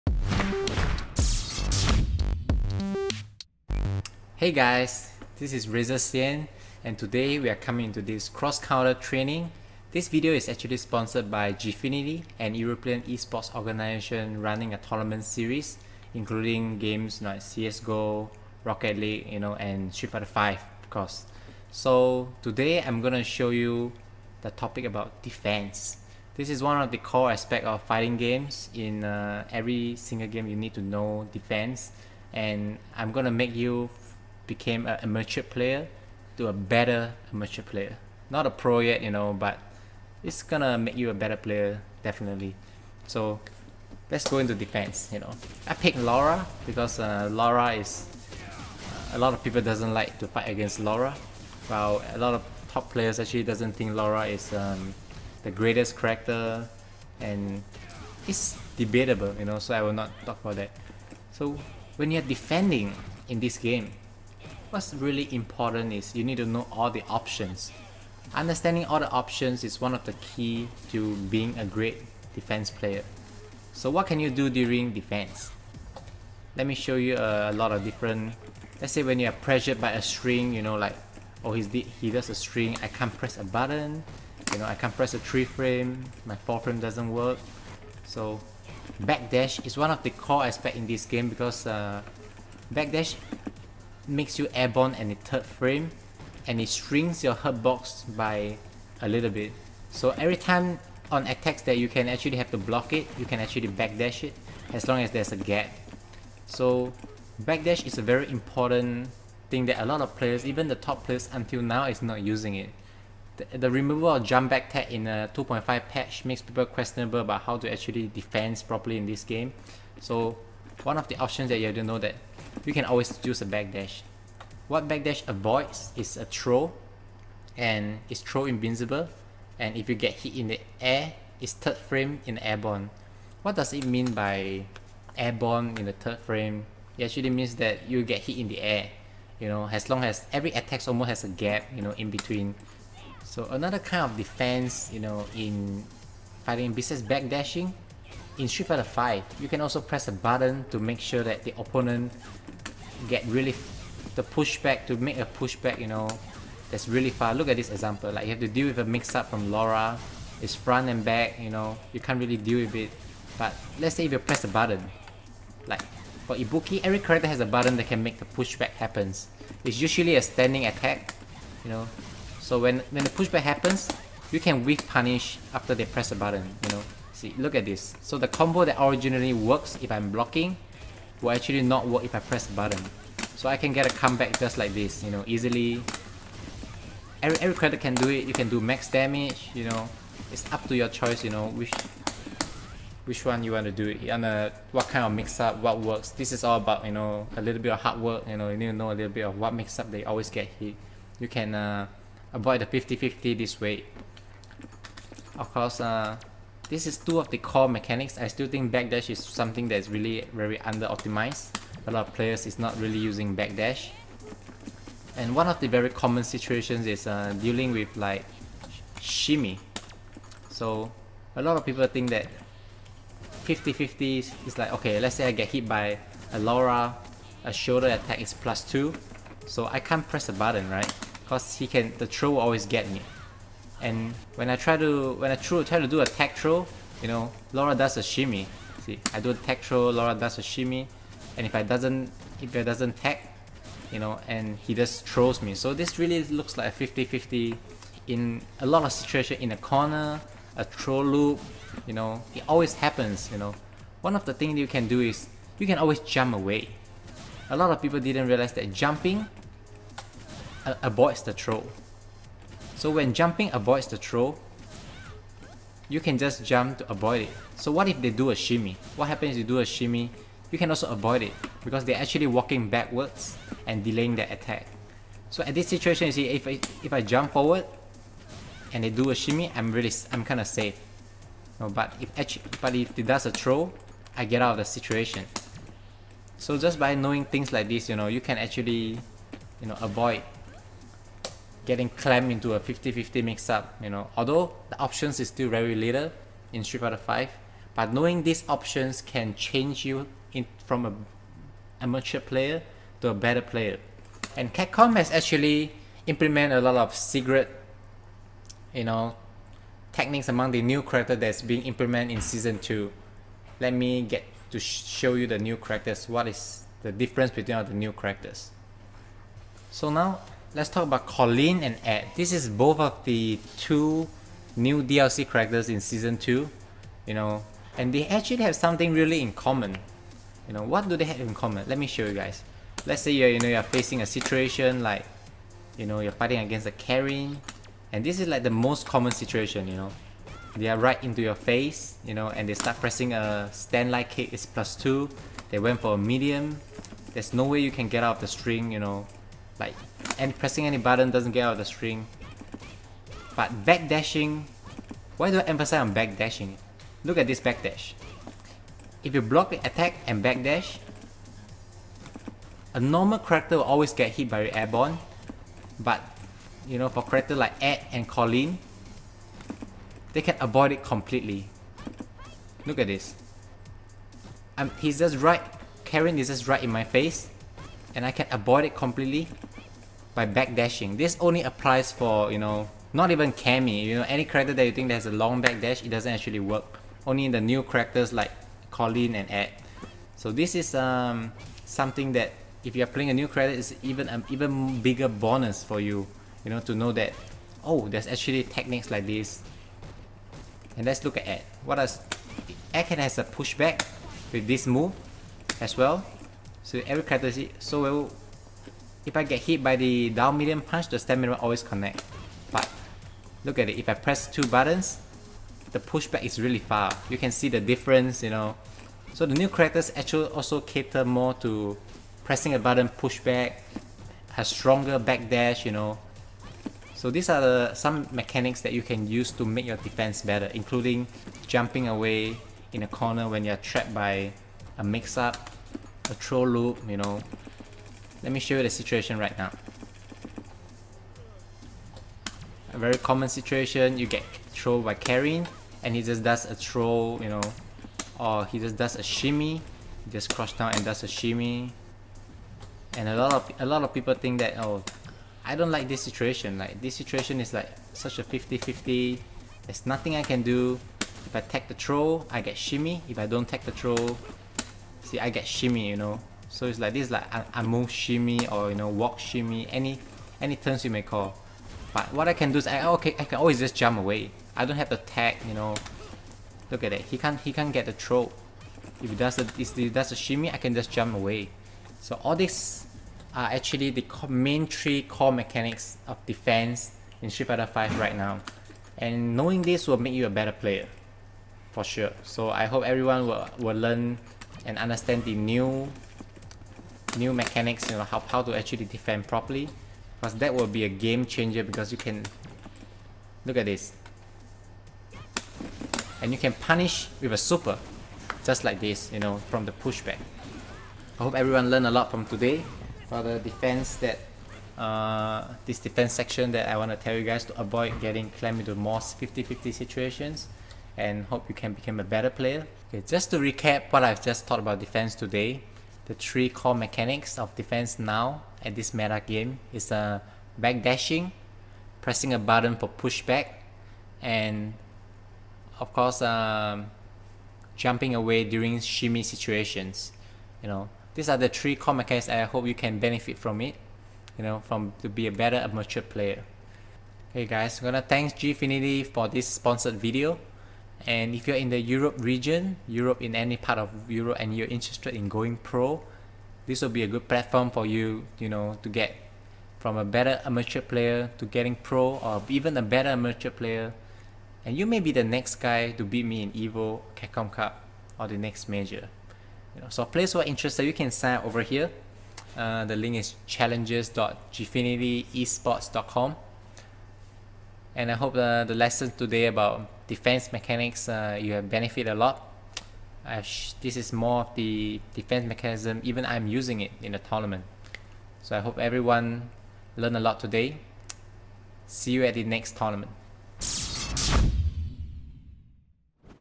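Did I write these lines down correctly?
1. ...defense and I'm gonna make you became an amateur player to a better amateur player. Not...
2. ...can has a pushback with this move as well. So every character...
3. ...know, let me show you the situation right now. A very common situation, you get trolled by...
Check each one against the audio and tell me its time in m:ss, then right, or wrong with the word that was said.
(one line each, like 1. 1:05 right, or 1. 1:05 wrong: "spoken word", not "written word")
1. 0:31 right
2. 6:42 right
3. 7:16 right.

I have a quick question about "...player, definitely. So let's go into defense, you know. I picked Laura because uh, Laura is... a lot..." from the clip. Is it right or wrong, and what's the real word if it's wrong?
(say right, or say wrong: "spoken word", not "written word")
right.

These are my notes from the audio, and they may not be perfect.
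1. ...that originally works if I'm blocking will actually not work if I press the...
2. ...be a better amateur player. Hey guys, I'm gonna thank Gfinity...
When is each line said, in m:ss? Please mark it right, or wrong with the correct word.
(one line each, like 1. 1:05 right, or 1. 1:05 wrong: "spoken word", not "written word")
1. 2:58 right
2. 9:05 right.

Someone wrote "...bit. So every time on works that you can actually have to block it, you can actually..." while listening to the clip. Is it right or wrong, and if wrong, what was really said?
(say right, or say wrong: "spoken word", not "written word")
wrong: "attacks", not "works".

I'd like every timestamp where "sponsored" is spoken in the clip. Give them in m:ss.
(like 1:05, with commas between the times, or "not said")
0:10, 9:09.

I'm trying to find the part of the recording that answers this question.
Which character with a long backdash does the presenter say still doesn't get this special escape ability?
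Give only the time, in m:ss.
6:23.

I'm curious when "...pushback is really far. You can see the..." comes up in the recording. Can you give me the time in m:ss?
6:55.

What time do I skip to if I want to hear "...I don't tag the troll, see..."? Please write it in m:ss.
7:43.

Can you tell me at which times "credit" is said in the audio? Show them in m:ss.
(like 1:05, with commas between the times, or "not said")
3:07.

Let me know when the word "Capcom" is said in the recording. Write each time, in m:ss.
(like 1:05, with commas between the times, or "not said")
5:04, 9:27.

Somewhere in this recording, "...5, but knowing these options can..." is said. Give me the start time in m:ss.
4:56.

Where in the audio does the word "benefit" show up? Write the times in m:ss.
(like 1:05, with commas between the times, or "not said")
9:02, 9:41.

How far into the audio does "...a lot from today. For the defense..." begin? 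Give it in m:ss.
8:31.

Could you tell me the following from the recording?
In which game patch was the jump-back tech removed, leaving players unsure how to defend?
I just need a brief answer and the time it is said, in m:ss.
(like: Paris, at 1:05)
2.5, at 1:55.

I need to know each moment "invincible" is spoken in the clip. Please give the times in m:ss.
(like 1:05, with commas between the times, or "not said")
2:08.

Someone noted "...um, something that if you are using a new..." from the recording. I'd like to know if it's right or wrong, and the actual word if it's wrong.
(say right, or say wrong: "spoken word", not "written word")
wrong: "playing", not "using".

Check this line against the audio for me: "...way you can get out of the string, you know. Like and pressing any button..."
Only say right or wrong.
right.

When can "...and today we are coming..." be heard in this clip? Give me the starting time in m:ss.
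0:06.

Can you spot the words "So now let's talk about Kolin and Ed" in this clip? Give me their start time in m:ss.
5:19.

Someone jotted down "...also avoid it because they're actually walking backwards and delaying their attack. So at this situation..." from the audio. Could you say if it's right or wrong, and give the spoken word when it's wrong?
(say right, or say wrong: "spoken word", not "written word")
right.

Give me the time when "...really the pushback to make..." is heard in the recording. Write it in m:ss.
2:33.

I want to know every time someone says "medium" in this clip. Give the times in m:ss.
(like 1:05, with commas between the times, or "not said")
5:45, 6:50.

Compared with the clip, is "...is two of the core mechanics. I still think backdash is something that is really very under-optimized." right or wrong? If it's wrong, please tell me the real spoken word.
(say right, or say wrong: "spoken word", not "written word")
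right.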